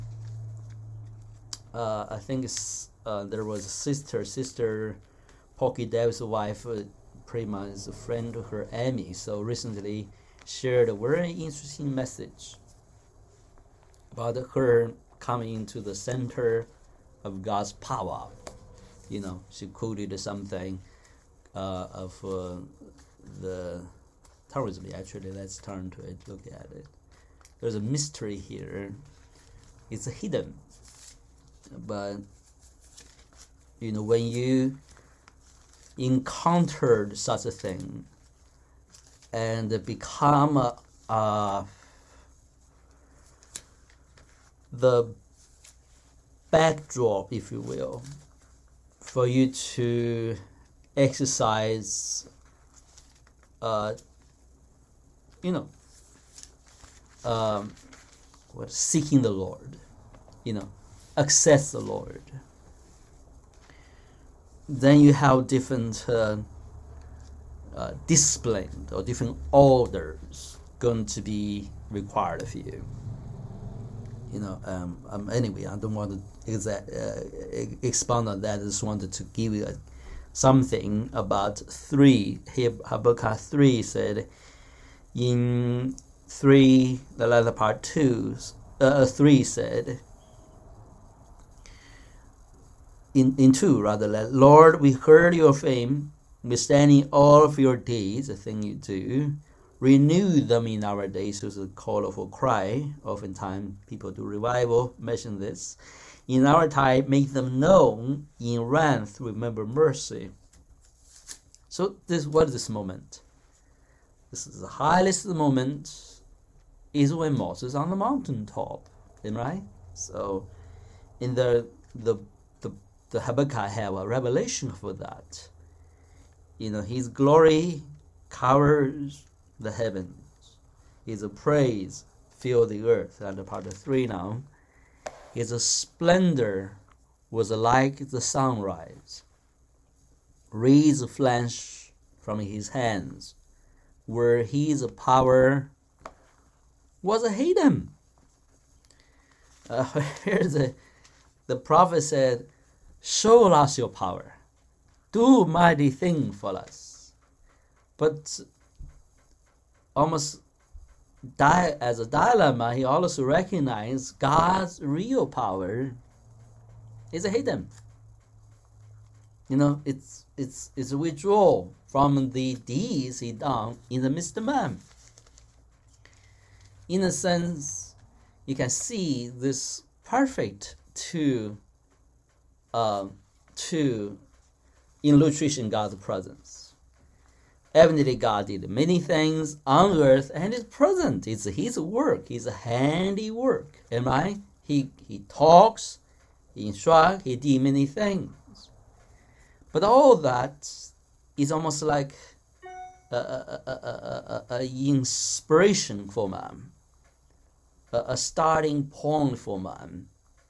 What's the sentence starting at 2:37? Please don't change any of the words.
But almost di- as a dilemma, he also recognized God's real power is hidden.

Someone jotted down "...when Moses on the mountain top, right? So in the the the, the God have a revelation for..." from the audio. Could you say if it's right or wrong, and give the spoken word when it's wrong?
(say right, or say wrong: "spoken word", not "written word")
wrong: "Habakkuk", not "God".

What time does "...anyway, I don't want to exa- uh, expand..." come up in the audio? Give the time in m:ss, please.
1:15.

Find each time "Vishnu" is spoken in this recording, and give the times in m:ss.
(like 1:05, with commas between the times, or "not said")
not said.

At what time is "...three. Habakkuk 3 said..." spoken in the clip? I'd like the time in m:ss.
1:21.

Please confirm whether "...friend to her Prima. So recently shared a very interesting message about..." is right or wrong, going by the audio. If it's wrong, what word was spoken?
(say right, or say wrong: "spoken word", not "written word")
wrong: "Emmy", not "Prima".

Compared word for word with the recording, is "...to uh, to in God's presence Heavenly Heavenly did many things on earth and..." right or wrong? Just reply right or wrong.
wrong.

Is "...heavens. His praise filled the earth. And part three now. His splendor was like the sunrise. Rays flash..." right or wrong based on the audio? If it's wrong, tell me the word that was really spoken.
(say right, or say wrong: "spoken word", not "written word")
right.